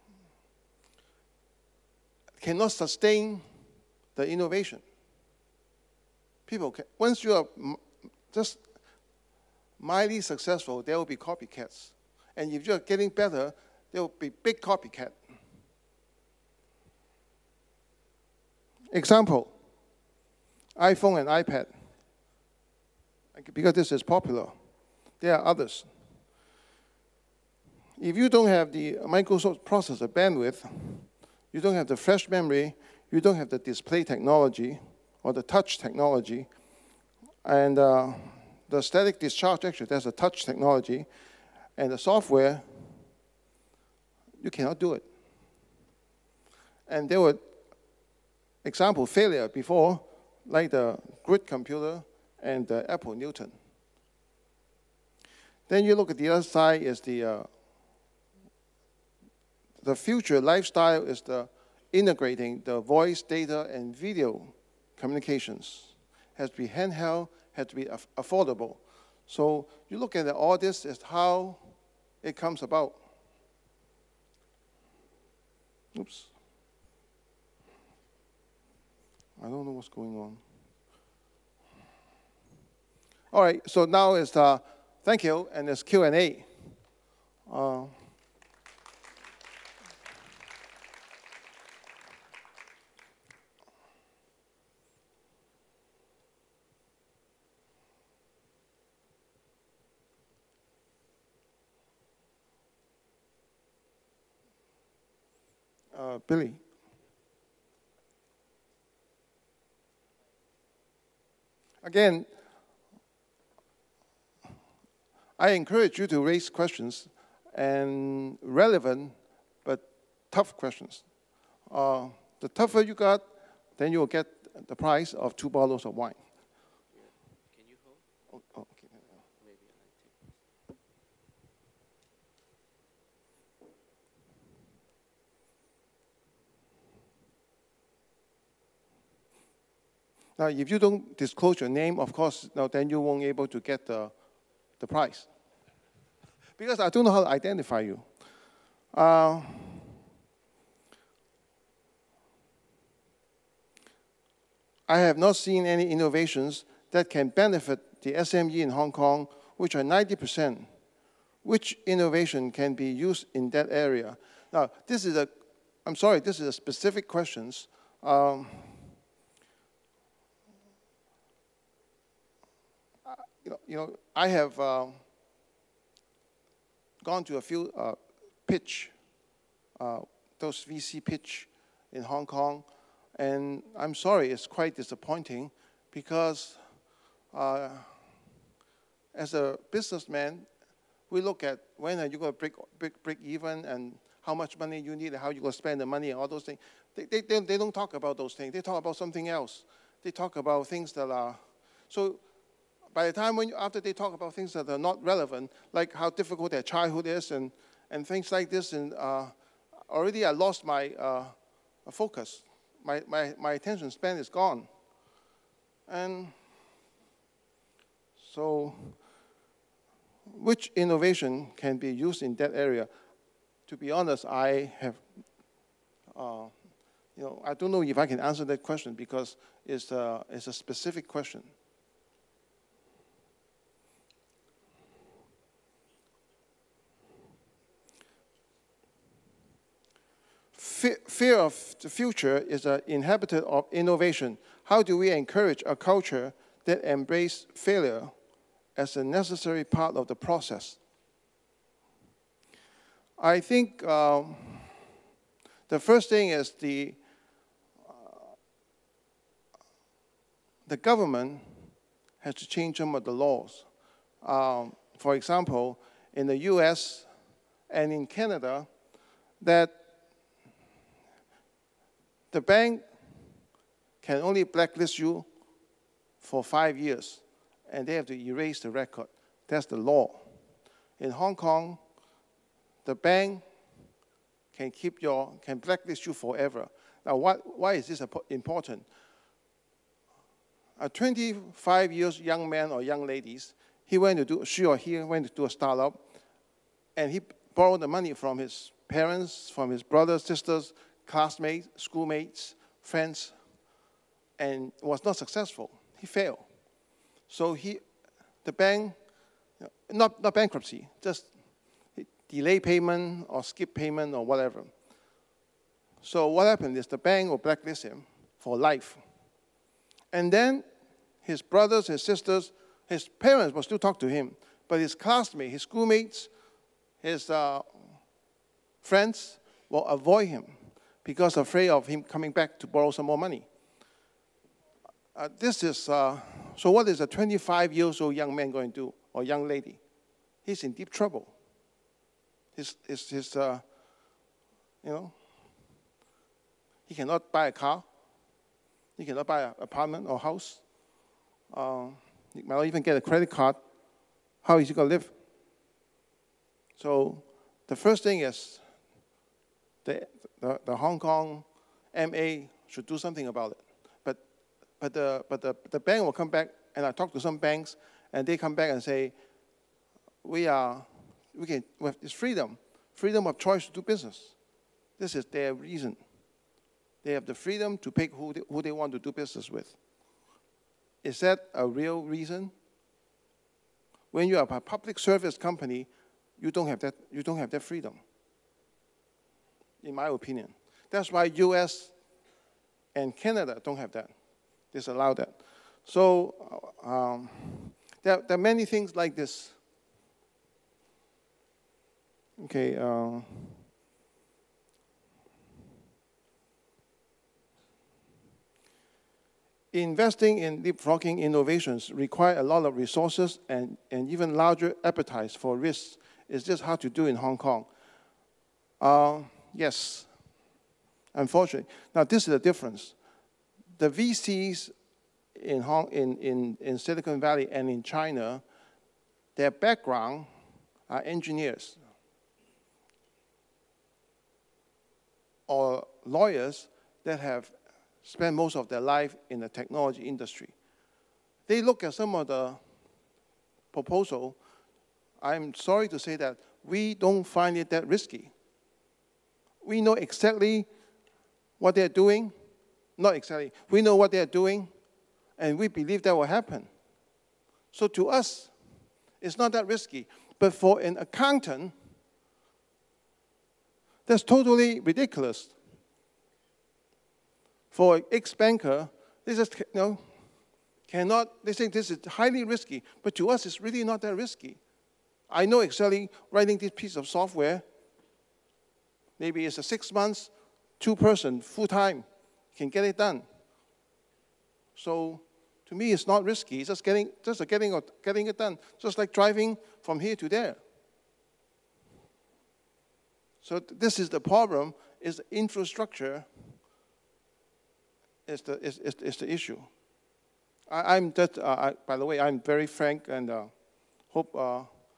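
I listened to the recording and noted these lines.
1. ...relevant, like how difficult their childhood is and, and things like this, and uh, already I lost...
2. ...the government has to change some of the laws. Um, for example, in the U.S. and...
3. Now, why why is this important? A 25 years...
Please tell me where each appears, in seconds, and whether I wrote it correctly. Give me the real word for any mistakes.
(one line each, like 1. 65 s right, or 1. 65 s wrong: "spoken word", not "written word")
1. 205 s right
2. 260 s right
3. 287 s right.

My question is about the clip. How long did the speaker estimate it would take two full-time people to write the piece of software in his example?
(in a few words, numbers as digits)
6 months.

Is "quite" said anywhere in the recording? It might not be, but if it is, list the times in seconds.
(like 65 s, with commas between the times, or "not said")
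184 s.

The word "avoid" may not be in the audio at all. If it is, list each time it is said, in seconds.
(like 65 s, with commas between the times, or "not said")
329 s.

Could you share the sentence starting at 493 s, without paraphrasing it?
So this is the problem, is the infrastructure is the, is, is, is the issue.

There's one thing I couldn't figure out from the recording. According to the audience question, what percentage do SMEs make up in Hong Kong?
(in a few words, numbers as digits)
90%.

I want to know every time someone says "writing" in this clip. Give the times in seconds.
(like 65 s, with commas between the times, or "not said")
476 s.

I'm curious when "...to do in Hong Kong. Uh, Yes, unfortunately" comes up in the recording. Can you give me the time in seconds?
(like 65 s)
416 s.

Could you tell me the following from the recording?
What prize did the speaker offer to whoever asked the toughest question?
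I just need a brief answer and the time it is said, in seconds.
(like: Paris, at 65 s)
two bottles of wine, at 125 s.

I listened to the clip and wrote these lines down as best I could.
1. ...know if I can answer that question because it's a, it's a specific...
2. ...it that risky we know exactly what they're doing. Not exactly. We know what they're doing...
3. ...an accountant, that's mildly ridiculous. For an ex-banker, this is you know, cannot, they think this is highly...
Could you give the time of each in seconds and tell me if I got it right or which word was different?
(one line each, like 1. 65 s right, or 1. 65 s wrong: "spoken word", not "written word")
1. 227 s right
2. 447 s right
3. 460 s wrong: "totally", not "mildly".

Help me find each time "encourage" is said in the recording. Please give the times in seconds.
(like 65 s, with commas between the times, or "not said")
115 s, 245 s.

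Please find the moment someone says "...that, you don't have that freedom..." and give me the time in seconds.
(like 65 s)
386 s.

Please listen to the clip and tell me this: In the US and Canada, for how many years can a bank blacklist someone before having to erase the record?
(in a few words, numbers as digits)
5 years.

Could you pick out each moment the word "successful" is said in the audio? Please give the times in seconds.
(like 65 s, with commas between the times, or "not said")
10 s, 305 s.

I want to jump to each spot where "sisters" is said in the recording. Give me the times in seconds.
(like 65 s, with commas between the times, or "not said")
300 s, 322 s.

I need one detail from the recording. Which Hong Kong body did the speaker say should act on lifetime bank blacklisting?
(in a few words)
Hong Kong MA.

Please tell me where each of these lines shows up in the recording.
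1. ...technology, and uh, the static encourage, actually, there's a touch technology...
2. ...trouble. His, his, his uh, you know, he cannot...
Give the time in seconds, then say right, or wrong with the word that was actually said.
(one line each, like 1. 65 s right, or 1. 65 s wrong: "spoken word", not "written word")
1. 35 s wrong: "discharge", not "encourage"
2. 340 s right.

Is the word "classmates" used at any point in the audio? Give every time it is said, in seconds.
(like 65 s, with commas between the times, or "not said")
301 s, 324 s.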